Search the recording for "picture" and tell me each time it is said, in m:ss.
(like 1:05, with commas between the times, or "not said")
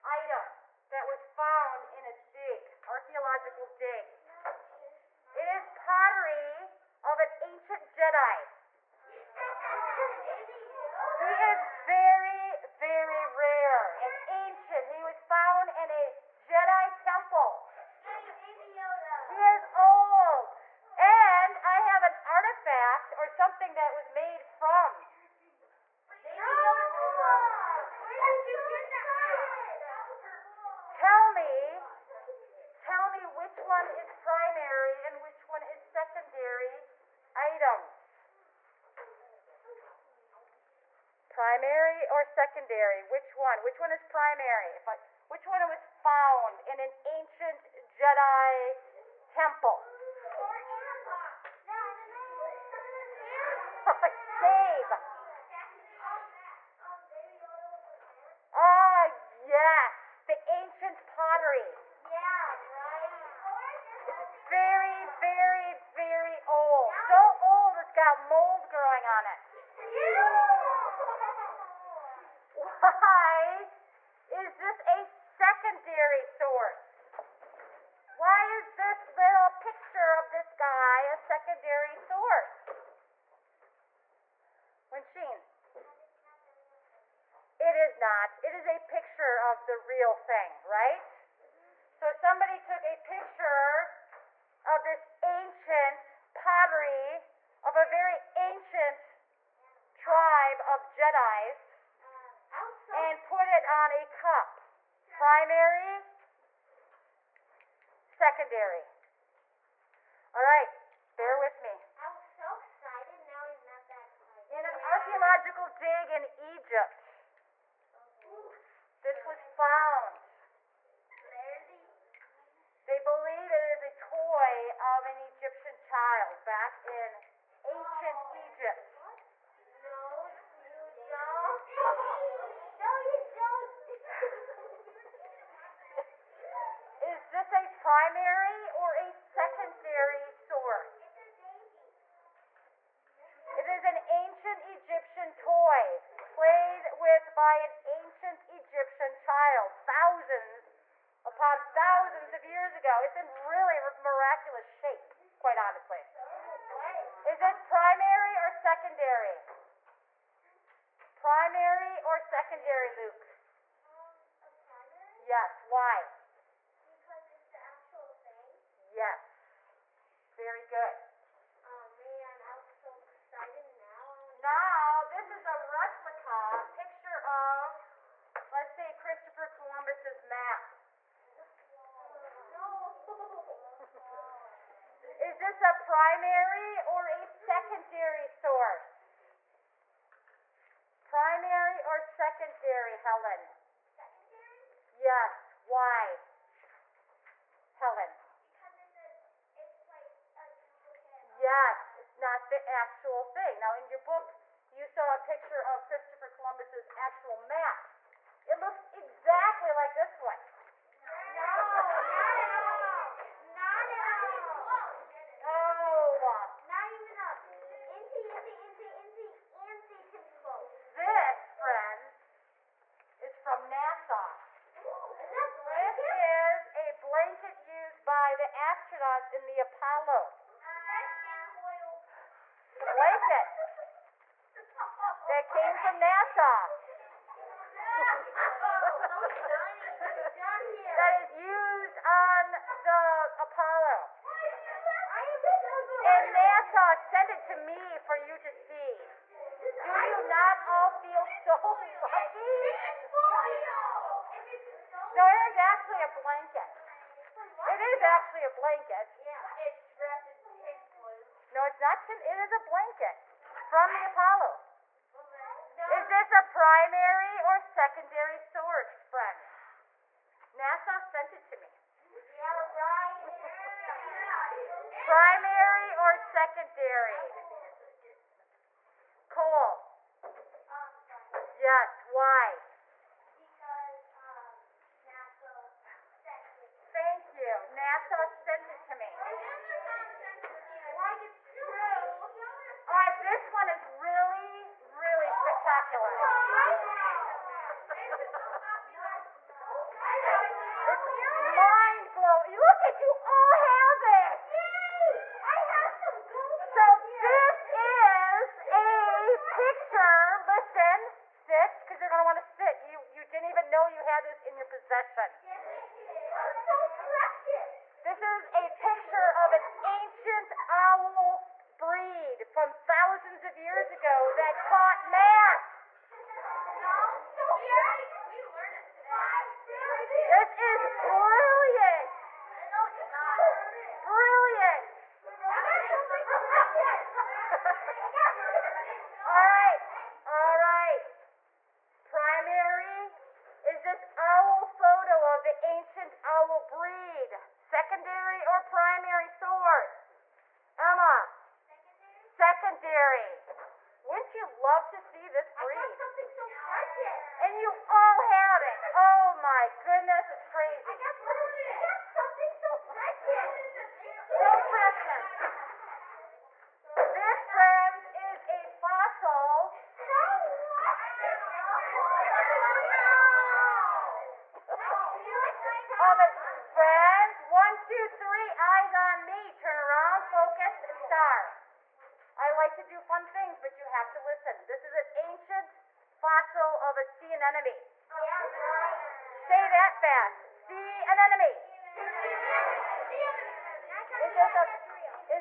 1:19, 1:28, 1:32, 2:56, 3:25, 5:18.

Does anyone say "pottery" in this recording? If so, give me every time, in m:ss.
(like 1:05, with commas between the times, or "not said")
0:05, 1:01, 1:36.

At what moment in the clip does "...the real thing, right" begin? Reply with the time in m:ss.
1:29.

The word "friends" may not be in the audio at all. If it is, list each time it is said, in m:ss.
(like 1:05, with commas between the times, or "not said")
3:41, 4:29, 6:07, 6:16.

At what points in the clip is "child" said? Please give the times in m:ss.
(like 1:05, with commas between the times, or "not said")
2:05, 2:29.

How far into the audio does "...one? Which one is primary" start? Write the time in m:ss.
0:43.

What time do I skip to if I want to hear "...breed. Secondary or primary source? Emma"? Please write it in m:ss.
5:46.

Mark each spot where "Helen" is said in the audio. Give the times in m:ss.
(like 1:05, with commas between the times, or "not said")
3:12, 3:17.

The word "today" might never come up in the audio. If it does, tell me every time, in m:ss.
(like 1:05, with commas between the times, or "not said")
5:28.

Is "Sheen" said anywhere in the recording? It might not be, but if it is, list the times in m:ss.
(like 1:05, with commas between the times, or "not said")
1:25.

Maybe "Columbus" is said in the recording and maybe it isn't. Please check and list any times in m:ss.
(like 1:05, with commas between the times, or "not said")
2:59, 3:26.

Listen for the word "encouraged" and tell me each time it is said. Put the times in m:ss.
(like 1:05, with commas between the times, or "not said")
not said.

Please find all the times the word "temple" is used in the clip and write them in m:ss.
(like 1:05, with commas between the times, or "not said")
0:17, 0:49.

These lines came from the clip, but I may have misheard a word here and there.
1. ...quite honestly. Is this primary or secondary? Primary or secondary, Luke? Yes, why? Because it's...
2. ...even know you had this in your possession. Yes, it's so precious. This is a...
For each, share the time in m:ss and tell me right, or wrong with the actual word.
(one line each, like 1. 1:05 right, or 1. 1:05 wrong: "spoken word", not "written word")
1. 2:35 right
2. 5:13 right.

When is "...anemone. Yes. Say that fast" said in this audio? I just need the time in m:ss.
6:27.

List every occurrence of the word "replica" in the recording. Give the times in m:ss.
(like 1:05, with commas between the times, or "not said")
2:55.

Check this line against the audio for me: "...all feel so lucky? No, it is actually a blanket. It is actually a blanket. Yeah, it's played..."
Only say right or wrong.
wrong.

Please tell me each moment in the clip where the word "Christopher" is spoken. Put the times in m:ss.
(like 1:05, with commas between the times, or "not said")
2:59, 3:25.